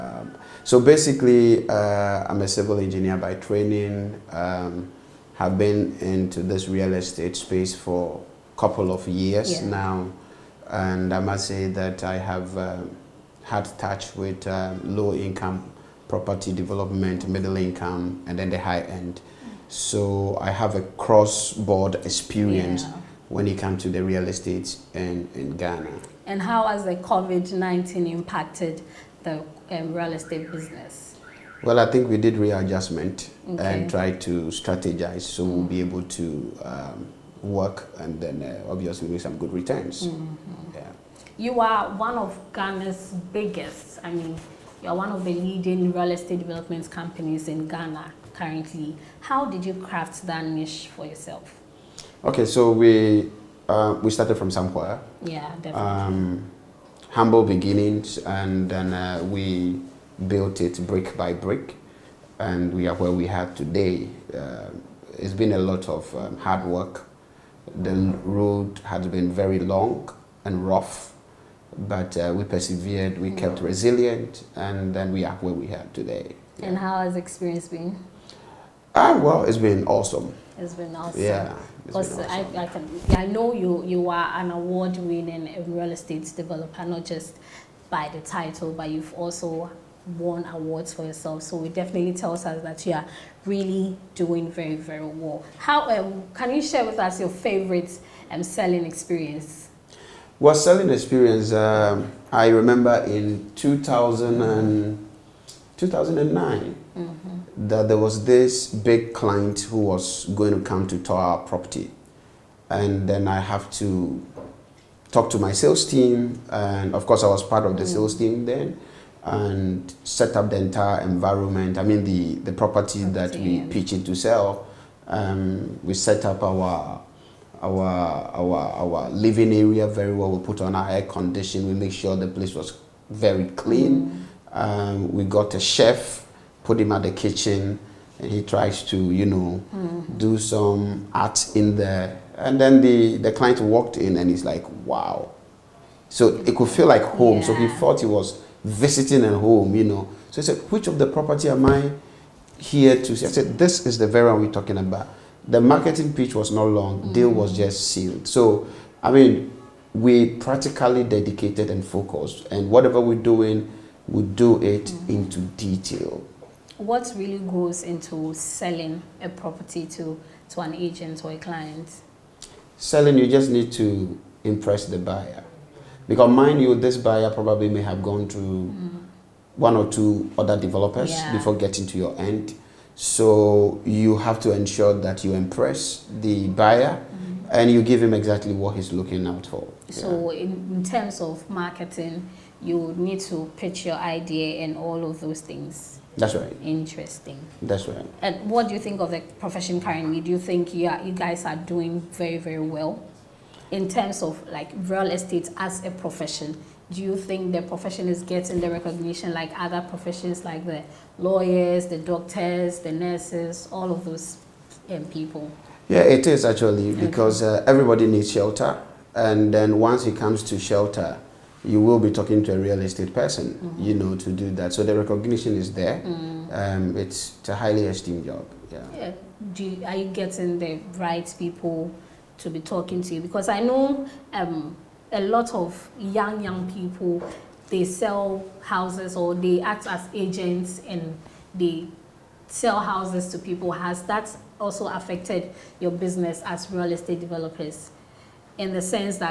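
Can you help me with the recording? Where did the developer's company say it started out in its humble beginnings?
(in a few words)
Samkwaya.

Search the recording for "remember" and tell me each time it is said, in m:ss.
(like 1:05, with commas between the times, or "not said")
1:42.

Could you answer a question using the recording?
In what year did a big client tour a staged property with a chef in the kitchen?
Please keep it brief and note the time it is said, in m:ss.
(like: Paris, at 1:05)
2009, at 1:45.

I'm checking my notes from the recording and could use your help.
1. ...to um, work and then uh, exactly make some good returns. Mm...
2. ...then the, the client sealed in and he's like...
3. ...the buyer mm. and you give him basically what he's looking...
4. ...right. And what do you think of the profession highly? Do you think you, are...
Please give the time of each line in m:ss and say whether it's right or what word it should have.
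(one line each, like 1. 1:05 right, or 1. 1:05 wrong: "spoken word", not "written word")
1. 0:36 wrong: "obviously", not "exactly"
2. 2:22 wrong: "walked", not "sealed"
3. 3:06 wrong: "exactly", not "basically"
4. 3:17 wrong: "currently", not "highly".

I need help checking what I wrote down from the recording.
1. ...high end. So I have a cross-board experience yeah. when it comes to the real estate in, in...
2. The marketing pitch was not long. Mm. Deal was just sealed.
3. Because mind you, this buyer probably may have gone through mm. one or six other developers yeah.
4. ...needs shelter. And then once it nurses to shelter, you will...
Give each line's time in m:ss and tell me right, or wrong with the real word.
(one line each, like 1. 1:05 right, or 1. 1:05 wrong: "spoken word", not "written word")
1. 0:18 right
2. 2:35 right
3. 2:56 wrong: "two", not "six"
4. 3:38 wrong: "comes", not "nurses".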